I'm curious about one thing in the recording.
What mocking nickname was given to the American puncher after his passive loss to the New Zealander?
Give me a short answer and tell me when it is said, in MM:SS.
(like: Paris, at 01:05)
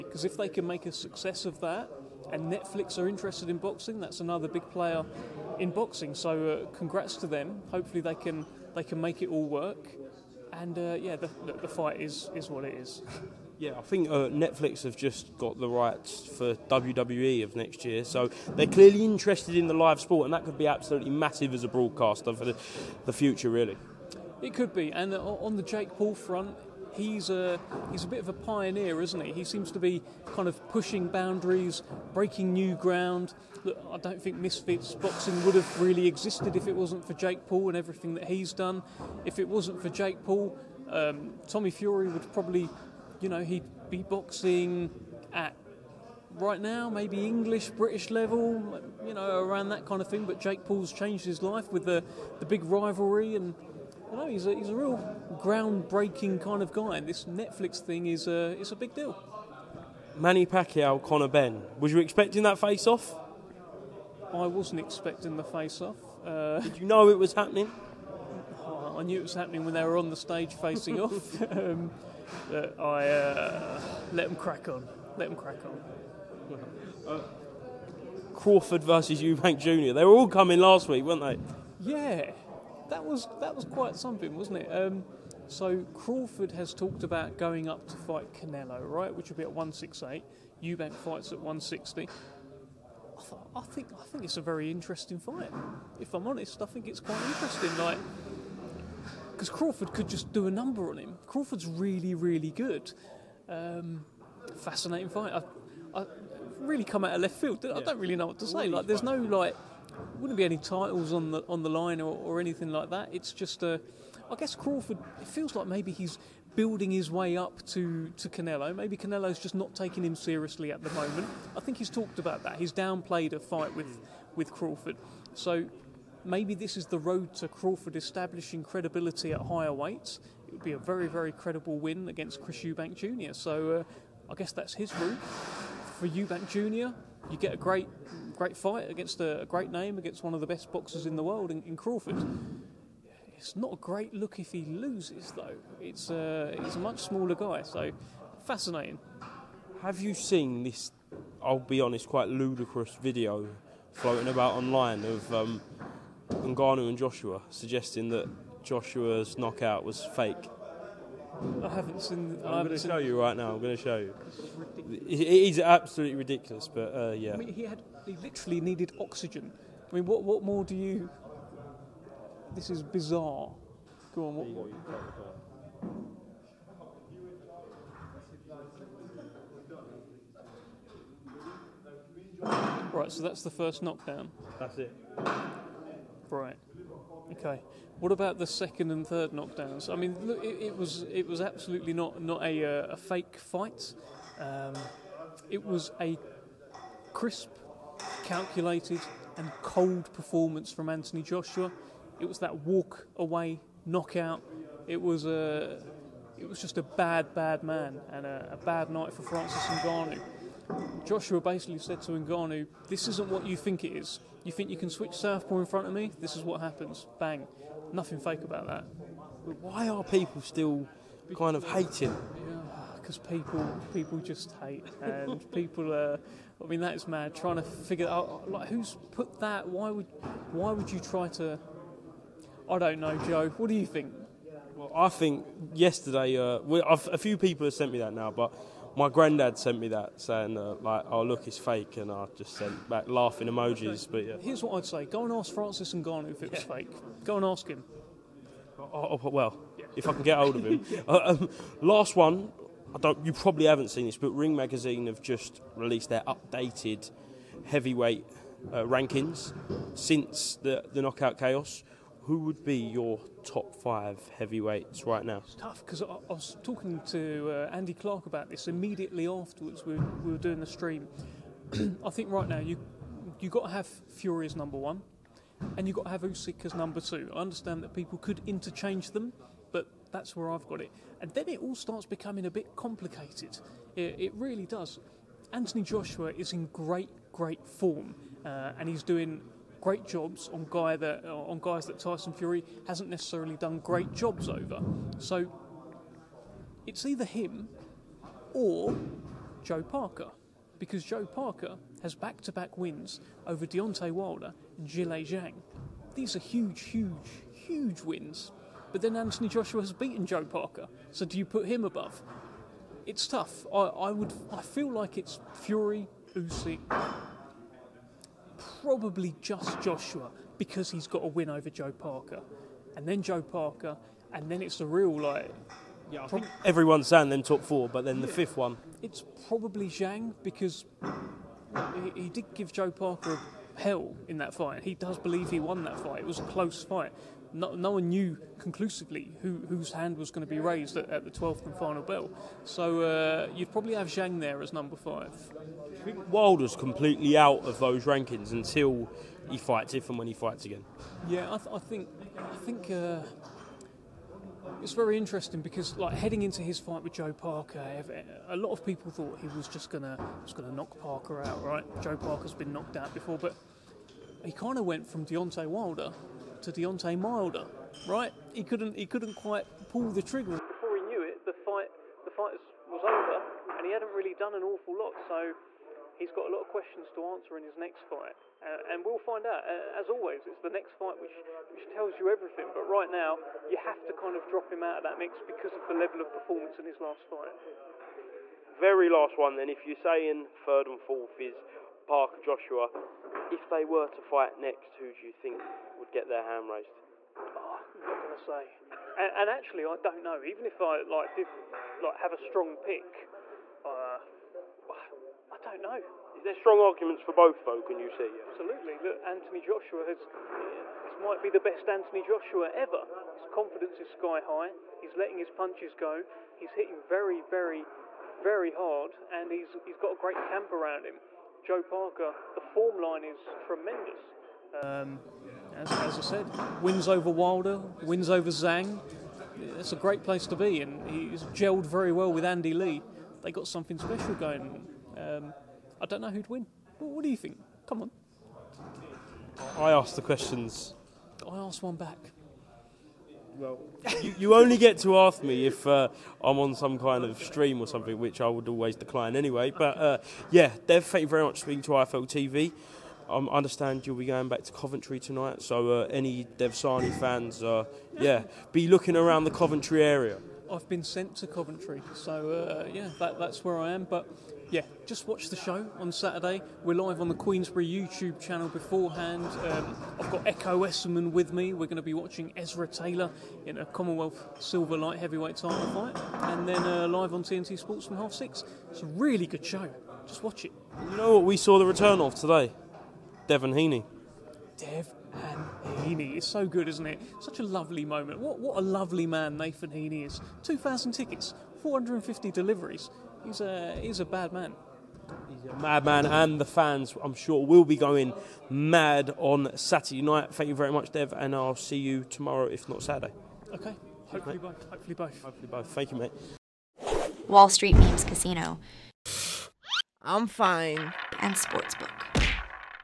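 Deontay Milder, at 06:06.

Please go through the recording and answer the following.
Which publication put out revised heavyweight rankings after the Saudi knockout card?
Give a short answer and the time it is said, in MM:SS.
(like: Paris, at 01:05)
Ring Magazine, at 04:14.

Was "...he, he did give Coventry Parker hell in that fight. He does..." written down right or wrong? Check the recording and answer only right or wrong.
wrong.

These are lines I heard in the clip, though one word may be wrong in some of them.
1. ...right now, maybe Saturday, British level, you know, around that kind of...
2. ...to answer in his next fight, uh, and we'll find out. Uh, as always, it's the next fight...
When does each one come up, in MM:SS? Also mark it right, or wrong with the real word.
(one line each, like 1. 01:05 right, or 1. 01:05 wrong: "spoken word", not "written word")
1. 00:46 wrong: "English", not "Saturday"
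2. 06:17 right.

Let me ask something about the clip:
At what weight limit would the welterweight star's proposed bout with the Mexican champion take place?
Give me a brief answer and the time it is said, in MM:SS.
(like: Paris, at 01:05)
168, at 01:29.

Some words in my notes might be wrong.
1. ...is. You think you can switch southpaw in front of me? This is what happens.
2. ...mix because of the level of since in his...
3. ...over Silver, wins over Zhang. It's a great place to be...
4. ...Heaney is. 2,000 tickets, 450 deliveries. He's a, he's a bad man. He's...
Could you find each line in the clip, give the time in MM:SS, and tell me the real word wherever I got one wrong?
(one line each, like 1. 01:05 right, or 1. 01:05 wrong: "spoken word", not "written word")
1. 03:33 right
2. 06:25 wrong: "performance", not "since"
3. 07:07 wrong: "Wilder", not "Silver"
4. 08:09 right.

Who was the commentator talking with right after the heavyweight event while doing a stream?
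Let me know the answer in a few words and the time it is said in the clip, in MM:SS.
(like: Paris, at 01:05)
Andy Clark, at 04:27.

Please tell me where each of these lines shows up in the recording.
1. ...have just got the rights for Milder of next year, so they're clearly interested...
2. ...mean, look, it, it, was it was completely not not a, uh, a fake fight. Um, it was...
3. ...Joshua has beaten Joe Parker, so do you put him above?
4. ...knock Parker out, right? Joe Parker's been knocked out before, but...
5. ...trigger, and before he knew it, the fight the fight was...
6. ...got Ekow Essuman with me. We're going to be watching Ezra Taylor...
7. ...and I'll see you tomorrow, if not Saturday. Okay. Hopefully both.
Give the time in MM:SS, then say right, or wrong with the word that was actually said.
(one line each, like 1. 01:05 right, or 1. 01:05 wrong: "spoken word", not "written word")
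1. 00:14 wrong: "WWE", not "Milder"
2. 03:09 wrong: "absolutely", not "completely"
3. 05:09 right
4. 06:00 right
5. 06:10 right
6. 07:50 right
7. 08:21 right.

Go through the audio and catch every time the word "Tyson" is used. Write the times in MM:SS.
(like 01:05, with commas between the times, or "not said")
04:51.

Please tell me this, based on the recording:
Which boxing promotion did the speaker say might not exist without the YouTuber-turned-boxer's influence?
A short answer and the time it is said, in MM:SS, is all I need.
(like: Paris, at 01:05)
Misfits, at 00:34.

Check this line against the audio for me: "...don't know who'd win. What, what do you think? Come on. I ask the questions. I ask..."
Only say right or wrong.
right.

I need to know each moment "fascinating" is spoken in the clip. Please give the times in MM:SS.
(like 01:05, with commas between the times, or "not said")
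01:44, 02:28.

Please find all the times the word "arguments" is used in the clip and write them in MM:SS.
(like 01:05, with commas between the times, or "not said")
06:46.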